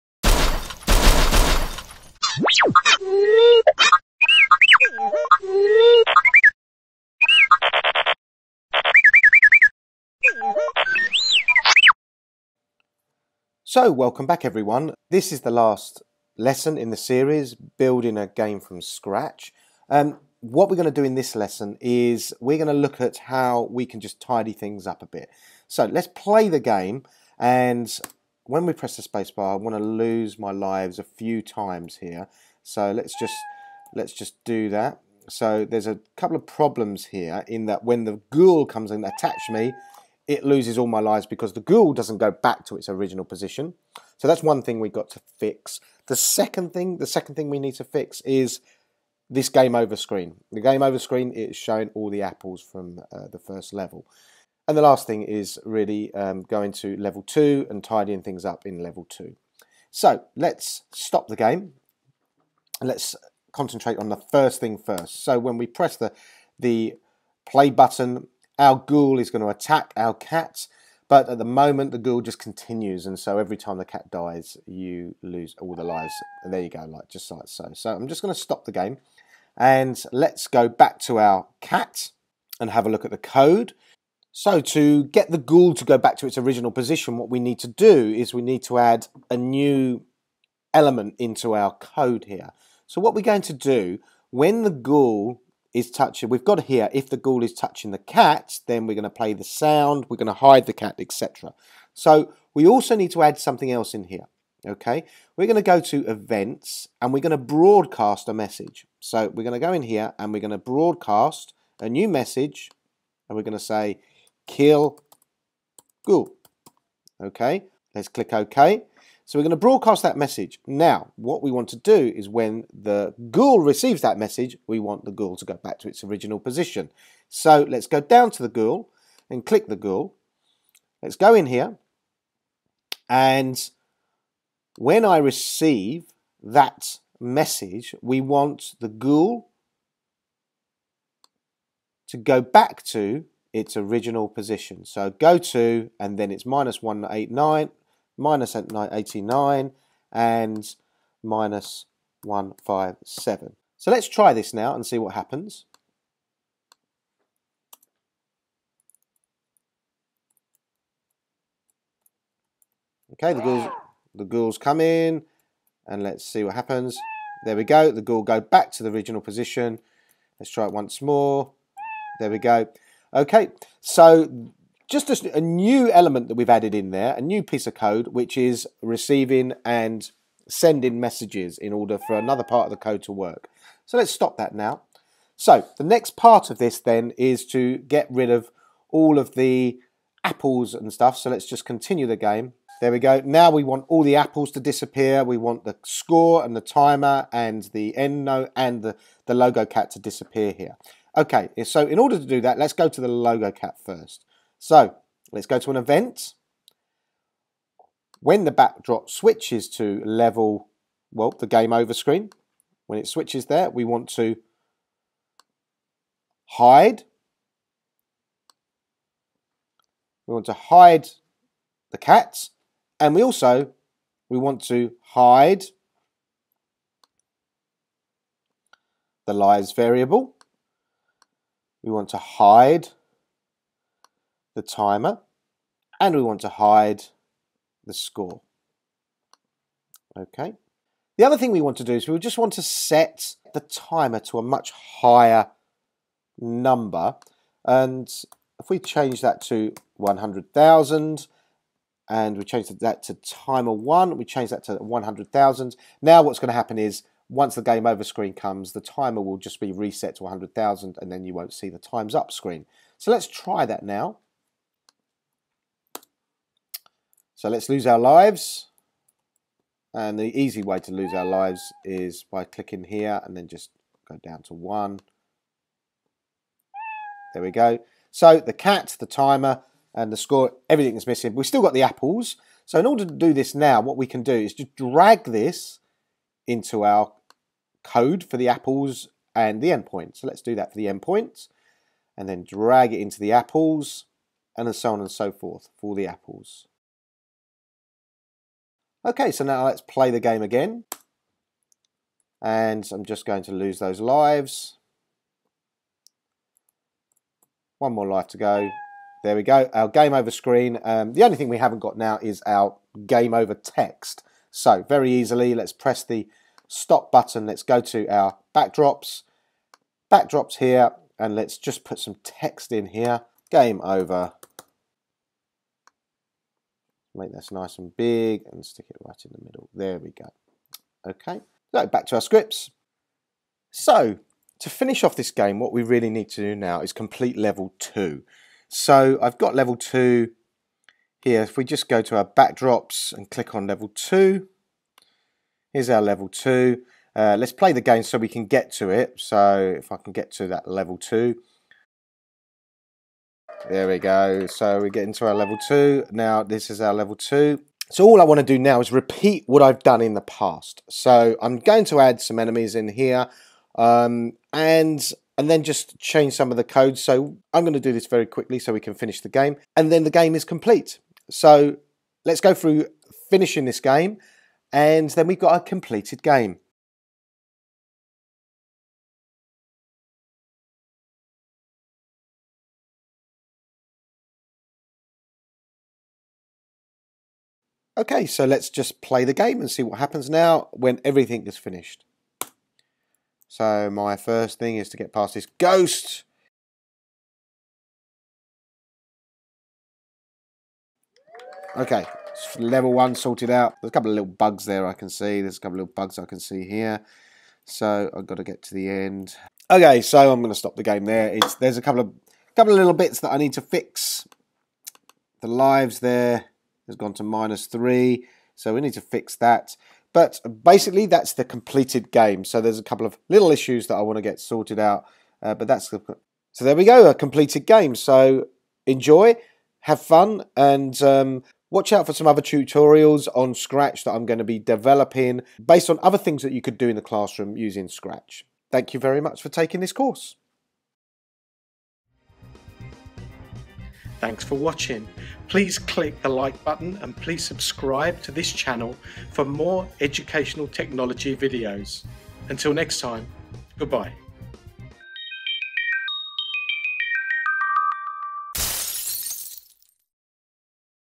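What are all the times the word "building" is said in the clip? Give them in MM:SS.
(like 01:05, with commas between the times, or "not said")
00:17.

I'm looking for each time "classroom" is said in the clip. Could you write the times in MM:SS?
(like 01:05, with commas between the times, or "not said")
07:17.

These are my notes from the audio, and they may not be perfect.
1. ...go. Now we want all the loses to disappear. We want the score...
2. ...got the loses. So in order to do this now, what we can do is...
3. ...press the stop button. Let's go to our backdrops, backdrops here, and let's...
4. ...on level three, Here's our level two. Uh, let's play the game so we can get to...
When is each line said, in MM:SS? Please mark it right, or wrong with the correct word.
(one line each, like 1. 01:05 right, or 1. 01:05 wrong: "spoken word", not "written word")
1. 03:12 wrong: "apples", not "loses"
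2. 04:41 wrong: "apples", not "loses"
3. 05:15 right
4. 05:43 wrong: "two", not "three".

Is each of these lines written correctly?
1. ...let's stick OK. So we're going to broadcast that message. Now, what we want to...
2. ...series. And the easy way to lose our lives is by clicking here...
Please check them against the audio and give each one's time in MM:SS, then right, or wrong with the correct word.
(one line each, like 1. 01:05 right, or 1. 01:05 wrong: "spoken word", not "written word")
1. 01:57 wrong: "click", not "stick"
2. 04:27 wrong: "lives", not "series".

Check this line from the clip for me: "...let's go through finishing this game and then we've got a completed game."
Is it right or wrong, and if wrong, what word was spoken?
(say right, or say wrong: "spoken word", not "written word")
right.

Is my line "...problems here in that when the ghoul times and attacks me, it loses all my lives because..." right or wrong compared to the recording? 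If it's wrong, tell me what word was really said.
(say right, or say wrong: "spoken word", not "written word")
wrong: "comes", not "times".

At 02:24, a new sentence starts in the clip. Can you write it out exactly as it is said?
So go to, and then it's minus 189, minus 89, and minus 157.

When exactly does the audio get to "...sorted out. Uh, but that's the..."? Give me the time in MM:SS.
07:04.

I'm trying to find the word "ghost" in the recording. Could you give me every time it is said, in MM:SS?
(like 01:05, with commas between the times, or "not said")
06:35.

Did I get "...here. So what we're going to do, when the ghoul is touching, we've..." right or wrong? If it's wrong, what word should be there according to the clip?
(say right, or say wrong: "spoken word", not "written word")
right.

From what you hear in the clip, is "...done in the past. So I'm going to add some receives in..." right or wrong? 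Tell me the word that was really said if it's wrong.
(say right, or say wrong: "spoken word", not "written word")
wrong: "enemies", not "receives".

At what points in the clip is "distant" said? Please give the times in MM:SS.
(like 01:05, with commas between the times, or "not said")
not said.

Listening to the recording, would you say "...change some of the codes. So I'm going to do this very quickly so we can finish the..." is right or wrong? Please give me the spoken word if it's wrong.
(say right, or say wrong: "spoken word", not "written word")
right.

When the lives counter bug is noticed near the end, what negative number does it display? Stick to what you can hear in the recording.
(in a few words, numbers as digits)
-3.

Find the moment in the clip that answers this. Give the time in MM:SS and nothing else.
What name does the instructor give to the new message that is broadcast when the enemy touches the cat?
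01:54.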